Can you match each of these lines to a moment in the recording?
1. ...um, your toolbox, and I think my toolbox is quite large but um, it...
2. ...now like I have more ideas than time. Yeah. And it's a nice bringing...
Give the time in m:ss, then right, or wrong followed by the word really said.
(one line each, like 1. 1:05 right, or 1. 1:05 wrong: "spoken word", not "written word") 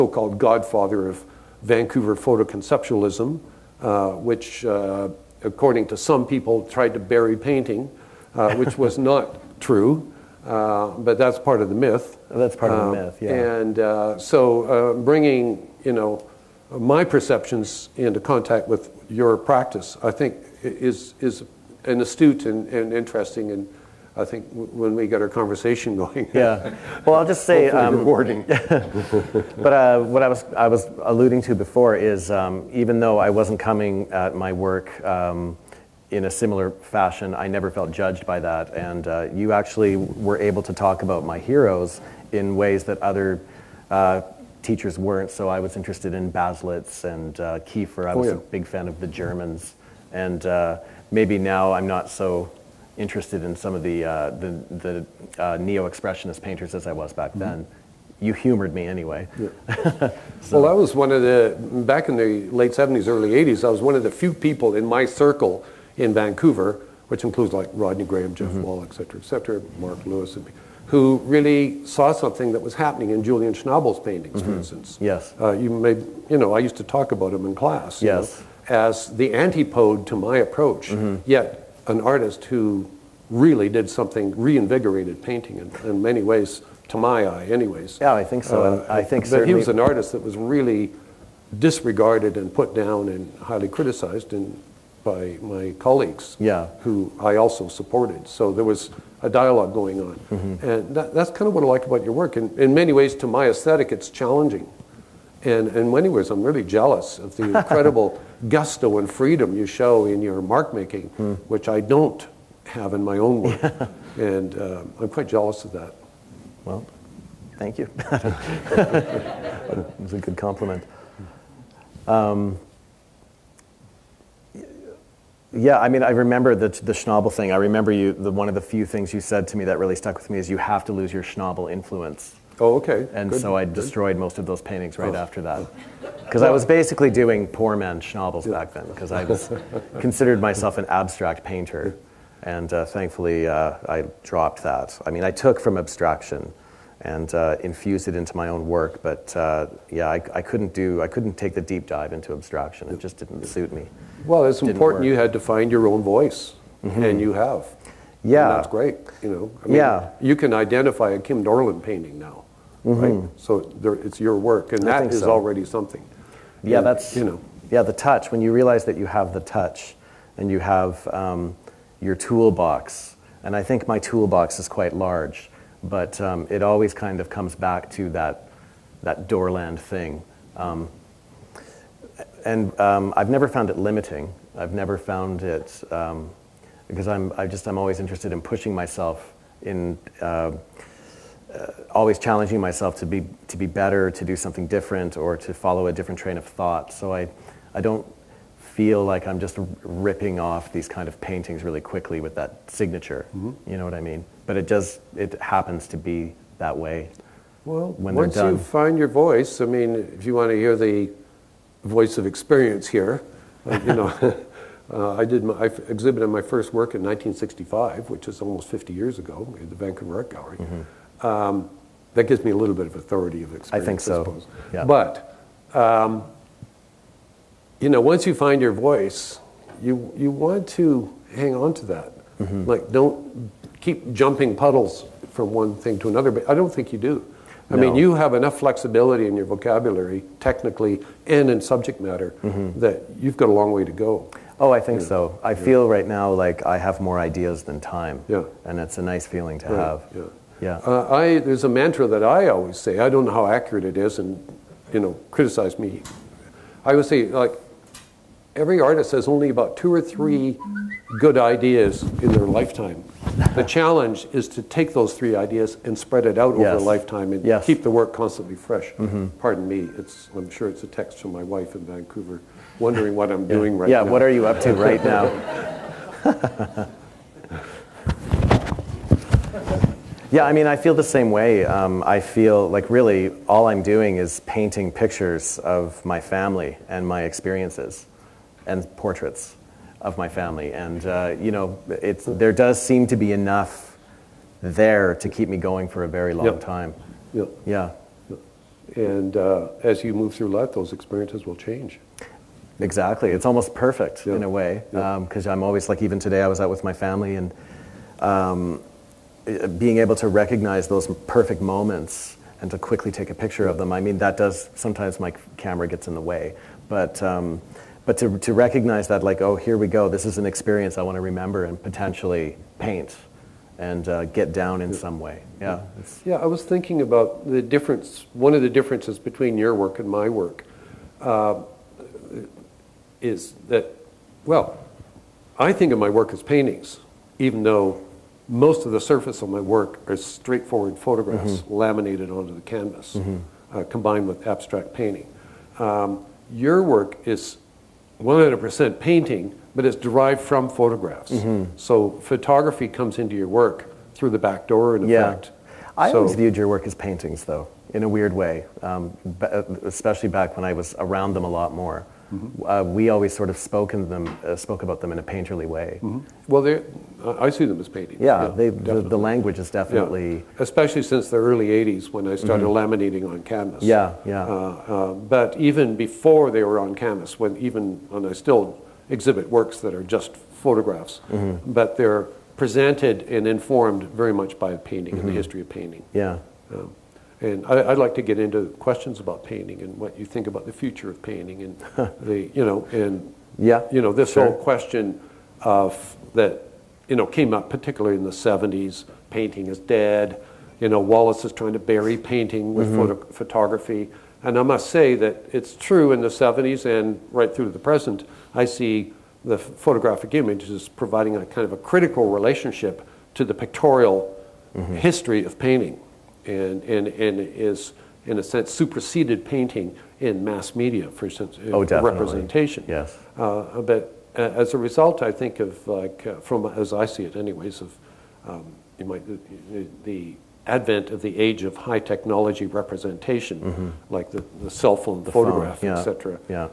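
1. 2:51 right
2. 4:06 wrong: "feeling", not "bringing".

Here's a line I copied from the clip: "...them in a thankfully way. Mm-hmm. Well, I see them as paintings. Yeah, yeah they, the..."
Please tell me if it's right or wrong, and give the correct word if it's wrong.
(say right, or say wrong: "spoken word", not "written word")
wrong: "painterly", not "thankfully".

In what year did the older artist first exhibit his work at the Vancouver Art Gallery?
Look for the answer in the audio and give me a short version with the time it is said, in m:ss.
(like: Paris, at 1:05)
1965, at 3:37.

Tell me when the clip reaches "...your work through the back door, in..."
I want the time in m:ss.
5:53.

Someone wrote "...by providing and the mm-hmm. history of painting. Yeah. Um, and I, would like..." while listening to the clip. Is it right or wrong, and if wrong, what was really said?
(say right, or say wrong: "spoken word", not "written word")
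wrong: "painting", not "providing".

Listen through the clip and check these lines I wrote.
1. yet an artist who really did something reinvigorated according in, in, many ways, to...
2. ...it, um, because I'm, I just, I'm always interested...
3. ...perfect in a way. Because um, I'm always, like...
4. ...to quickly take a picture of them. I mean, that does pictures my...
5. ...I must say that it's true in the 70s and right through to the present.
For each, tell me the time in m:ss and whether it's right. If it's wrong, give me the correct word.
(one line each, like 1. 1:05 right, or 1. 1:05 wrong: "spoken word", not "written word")
1. 1:21 wrong: "painting", not "according"
2. 3:05 right
3. 5:03 right
4. 5:12 wrong: "sometimes", not "pictures"
5. 6:44 right.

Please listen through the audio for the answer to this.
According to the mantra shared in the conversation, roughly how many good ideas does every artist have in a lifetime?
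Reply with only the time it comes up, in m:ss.
4:19.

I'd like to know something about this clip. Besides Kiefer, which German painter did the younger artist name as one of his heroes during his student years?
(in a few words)
Baselitz.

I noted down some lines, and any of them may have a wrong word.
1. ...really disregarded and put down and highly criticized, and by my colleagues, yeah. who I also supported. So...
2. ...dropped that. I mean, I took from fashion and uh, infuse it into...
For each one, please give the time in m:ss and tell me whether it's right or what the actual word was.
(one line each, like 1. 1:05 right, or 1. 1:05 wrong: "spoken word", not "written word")
1. 1:30 right
2. 2:24 wrong: "abstraction", not "fashion".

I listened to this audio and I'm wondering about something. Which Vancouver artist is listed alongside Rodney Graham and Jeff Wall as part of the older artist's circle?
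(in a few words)
Mark Lewis.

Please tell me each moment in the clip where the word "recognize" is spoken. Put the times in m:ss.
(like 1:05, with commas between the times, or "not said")
5:10, 5:18.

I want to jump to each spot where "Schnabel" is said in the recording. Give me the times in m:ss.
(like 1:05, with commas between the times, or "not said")
1:13, 2:06, 2:11, 2:18.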